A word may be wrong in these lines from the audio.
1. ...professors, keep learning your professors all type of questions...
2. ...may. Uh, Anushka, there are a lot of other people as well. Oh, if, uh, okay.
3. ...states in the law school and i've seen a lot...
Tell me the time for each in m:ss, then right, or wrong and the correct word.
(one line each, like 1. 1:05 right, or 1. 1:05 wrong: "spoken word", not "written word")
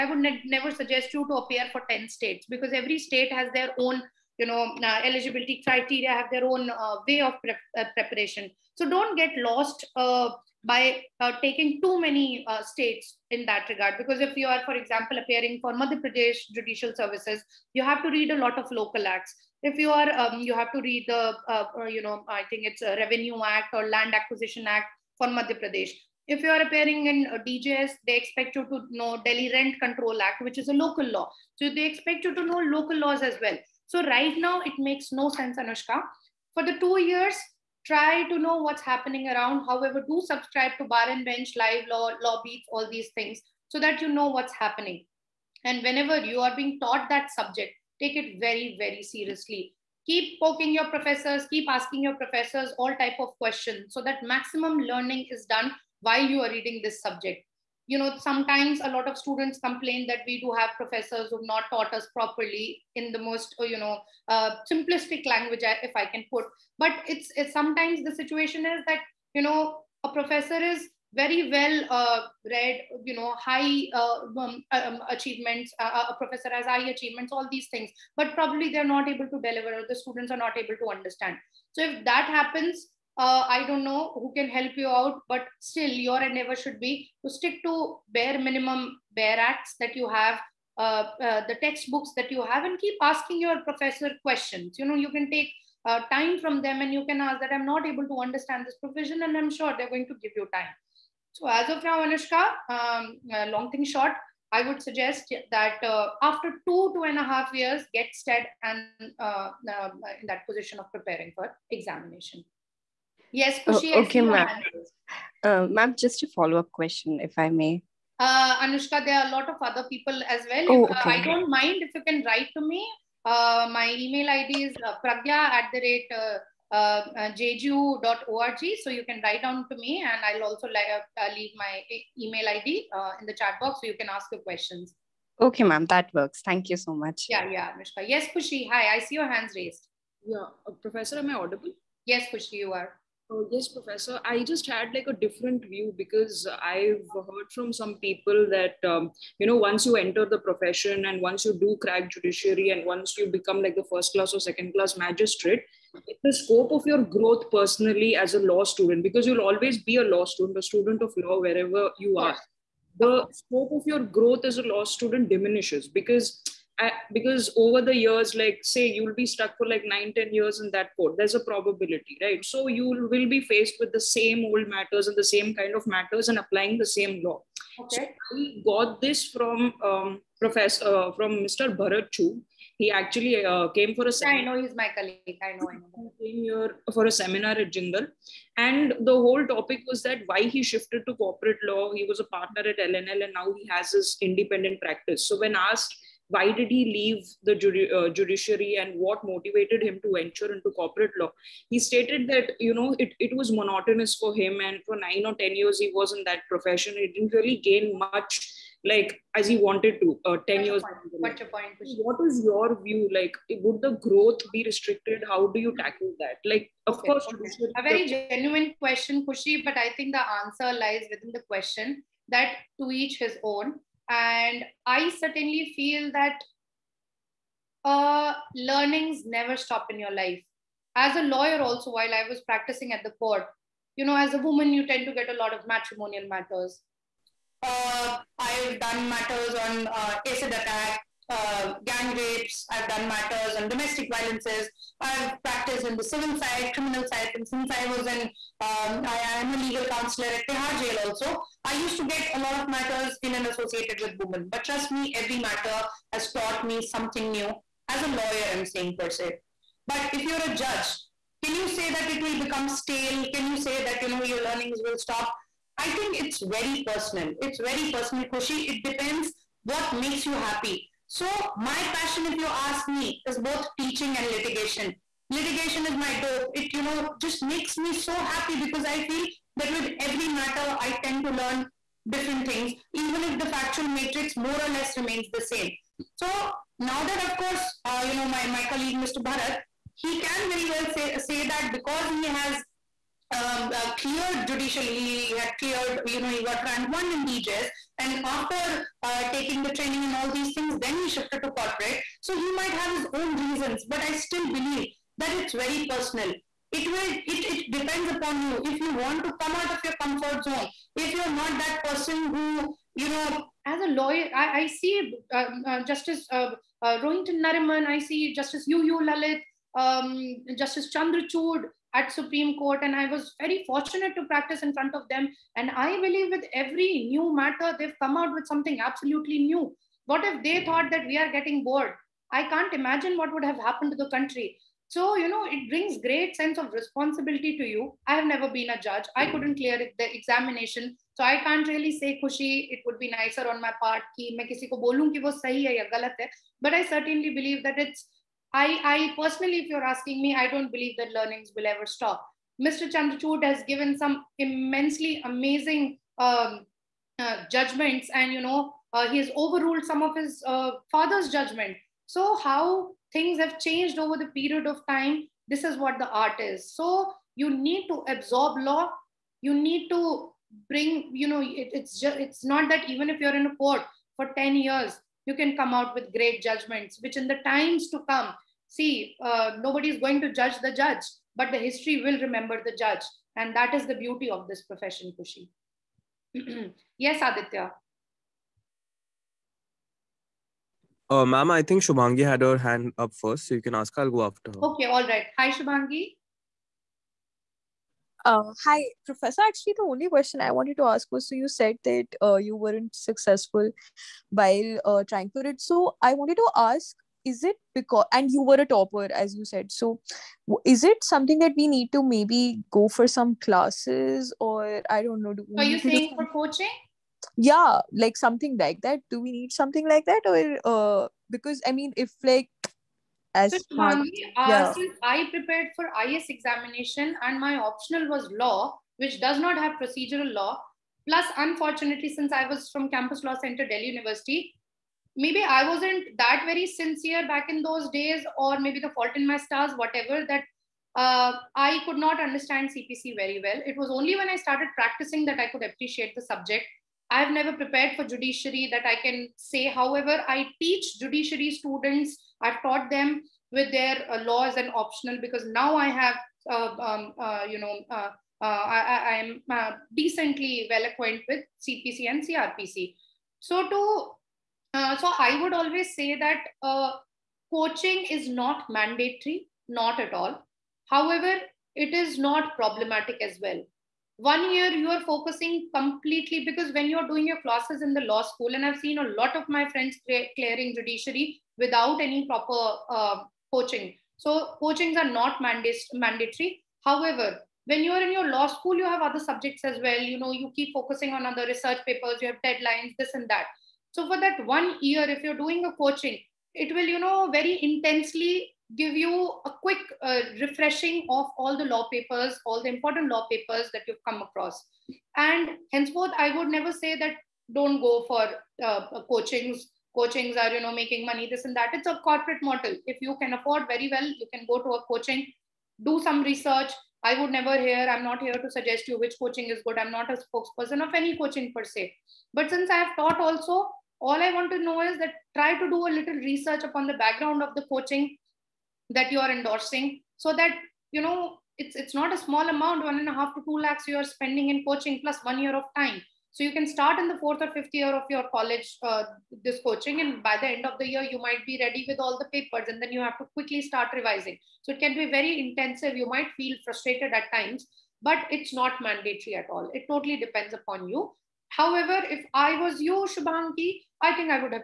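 1. 0:50 wrong: "asking", not "learning"
2. 1:57 right
3. 7:57 wrong: "classes", not "states".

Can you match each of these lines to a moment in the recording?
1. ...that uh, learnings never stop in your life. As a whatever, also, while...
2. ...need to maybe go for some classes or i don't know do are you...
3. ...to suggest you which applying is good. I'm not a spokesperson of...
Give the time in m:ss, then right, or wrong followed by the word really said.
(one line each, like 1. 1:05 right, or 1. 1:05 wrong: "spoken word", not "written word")
1. 3:46 wrong: "lawyer", not "whatever"
2. 6:51 right
3. 8:38 wrong: "coaching", not "applying".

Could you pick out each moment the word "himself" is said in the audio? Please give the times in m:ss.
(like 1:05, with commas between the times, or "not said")
not said.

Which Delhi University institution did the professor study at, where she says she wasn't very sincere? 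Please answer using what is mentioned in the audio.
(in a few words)
Campus Law Center.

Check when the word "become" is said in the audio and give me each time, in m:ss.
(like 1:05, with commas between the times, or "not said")
2:33, 4:22.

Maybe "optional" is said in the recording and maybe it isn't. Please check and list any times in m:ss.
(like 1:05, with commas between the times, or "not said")
7:07, 7:34.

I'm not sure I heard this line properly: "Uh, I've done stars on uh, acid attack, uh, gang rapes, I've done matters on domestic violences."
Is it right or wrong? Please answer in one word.
wrong.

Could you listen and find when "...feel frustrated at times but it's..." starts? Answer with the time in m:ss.
9:06.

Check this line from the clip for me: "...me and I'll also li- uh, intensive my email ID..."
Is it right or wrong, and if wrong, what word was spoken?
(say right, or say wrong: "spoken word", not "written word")
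wrong: "leave", not "intensive".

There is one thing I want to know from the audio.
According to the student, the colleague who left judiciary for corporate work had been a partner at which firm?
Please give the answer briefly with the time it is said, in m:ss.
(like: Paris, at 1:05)
L&L, at 3:12.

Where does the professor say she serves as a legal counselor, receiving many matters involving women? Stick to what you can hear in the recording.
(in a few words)
Tihar Jail.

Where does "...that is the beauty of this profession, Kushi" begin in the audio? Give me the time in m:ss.
6:23.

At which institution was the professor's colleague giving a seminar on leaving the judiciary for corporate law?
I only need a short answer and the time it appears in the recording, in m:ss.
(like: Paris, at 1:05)
Jindal, at 3:07.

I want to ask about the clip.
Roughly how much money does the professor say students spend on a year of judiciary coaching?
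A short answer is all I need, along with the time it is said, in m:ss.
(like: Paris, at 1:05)
1.5 to 2 lakhs, at 8:52.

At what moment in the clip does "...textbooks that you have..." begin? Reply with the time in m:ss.
1:31.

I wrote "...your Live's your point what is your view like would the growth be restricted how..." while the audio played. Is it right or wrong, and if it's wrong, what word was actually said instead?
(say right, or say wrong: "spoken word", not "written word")
wrong: "What", not "Live".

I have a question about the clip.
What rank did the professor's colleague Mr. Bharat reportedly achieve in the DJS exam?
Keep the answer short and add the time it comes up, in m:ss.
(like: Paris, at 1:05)
1, at 4:56.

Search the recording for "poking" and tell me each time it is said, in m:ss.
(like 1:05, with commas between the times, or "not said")
0:50.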